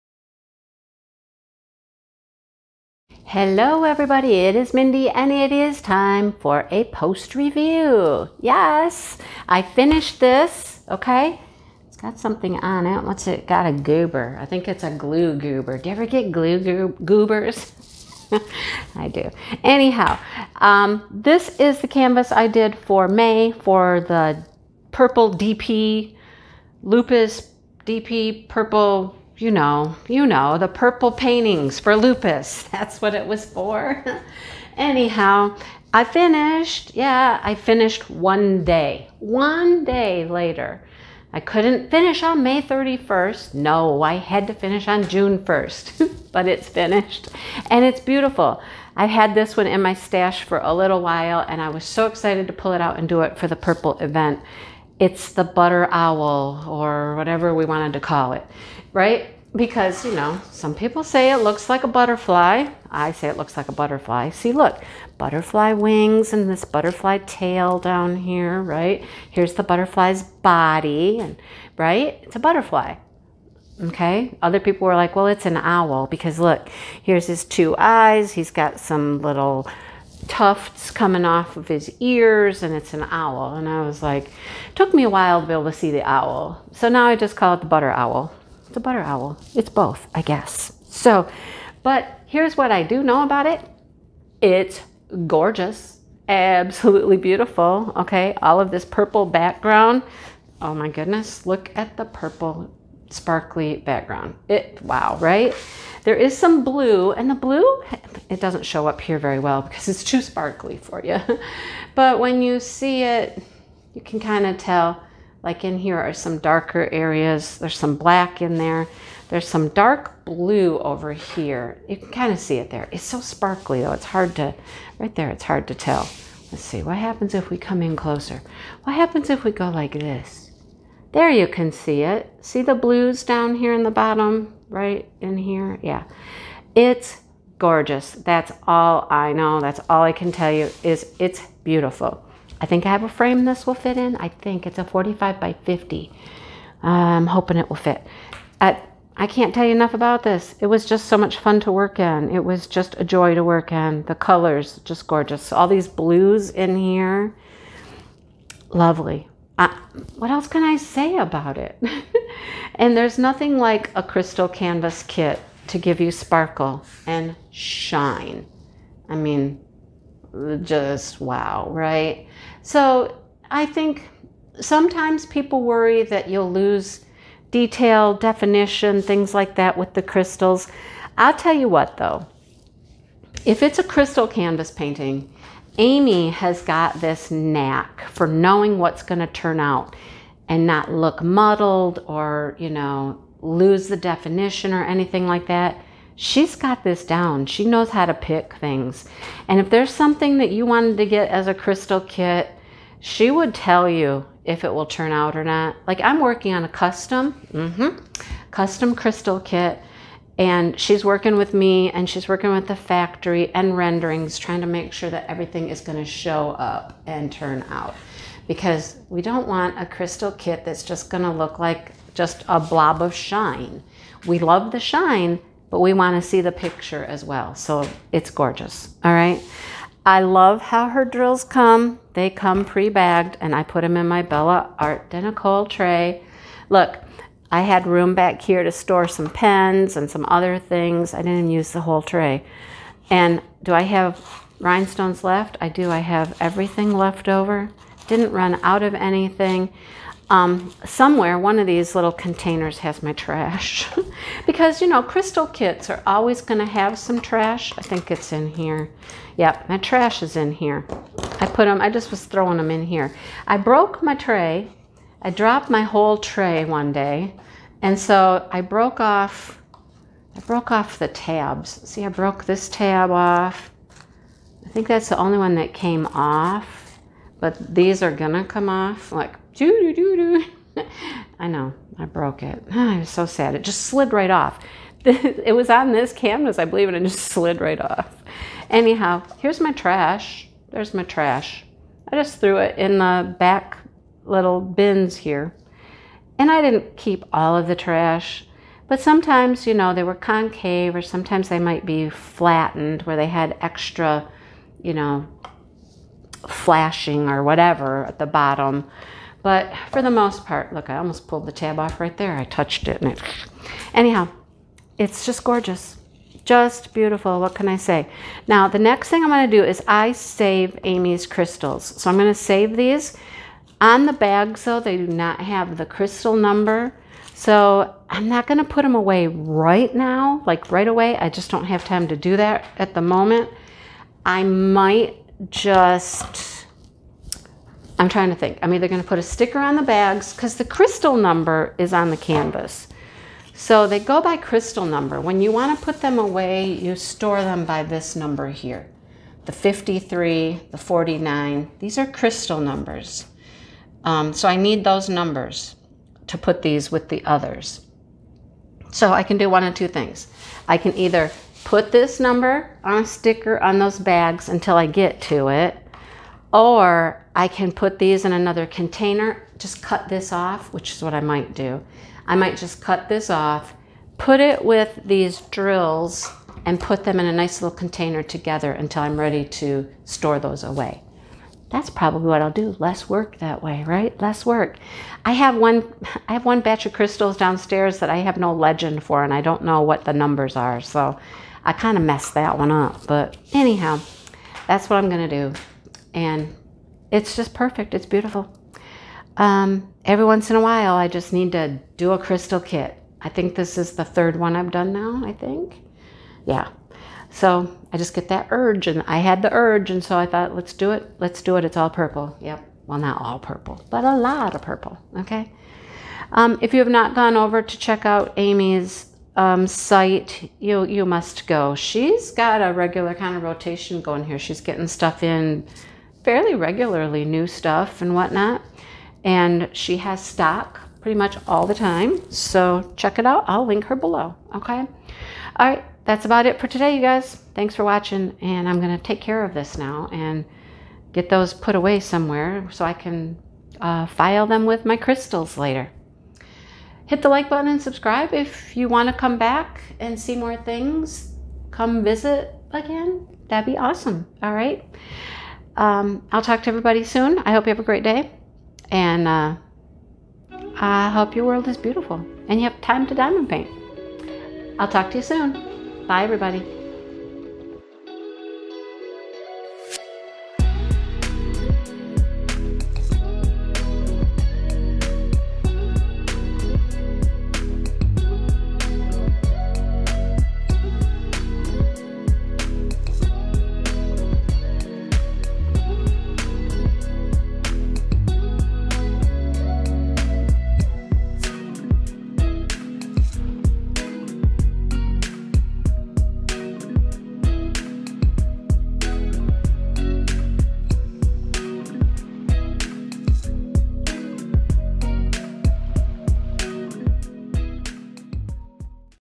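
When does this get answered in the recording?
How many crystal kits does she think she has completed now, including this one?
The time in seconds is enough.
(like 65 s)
404 s.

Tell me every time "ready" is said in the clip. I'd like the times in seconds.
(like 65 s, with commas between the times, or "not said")
379 s.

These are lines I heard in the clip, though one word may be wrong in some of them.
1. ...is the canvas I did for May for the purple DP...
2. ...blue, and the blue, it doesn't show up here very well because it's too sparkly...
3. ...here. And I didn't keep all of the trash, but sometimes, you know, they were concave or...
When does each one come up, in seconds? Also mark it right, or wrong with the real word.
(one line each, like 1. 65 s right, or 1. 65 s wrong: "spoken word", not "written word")
1. 21 s right
2. 106 s right
3. 295 s right.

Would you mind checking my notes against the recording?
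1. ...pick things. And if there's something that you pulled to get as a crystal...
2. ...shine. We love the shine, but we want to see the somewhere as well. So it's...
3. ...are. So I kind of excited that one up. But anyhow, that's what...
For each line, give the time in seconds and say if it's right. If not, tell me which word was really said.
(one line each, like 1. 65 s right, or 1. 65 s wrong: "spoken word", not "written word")
1. 198 s wrong: "wanted", not "pulled"
2. 223 s wrong: "picture", not "somewhere"
3. 390 s wrong: "messed", not "excited".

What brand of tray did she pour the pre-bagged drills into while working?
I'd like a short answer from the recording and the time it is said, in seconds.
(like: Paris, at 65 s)
Bella Art, at 234 s.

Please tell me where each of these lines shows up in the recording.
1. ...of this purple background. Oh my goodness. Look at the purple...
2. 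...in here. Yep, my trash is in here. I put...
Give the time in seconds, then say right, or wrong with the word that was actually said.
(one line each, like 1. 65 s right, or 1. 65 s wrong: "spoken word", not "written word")
1. 98 s right
2. 258 s right.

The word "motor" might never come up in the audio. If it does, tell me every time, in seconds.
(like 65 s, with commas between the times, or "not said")
not said.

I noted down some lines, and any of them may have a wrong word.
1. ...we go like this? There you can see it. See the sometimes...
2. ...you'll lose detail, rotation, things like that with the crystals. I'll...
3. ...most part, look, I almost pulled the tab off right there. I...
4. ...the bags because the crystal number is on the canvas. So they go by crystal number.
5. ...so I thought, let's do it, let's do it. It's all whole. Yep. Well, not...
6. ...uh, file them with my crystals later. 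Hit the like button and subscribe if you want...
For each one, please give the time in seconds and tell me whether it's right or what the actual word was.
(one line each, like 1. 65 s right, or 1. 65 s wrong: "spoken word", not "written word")
1. 129 s wrong: "blues", not "sometimes"
2. 176 s wrong: "definition", not "rotation"
3. 310 s right
4. 339 s right
5. 410 s wrong: "purple", not "whole"
6. 443 s right.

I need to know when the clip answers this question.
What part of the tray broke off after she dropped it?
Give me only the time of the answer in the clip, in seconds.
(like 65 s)
271 s.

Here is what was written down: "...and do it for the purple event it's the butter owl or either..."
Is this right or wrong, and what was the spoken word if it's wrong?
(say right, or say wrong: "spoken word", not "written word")
wrong: "whatever", not "either".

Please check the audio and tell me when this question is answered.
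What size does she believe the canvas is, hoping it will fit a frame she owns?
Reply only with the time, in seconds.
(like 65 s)
144 s.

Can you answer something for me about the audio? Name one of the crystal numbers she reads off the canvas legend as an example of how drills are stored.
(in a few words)
53.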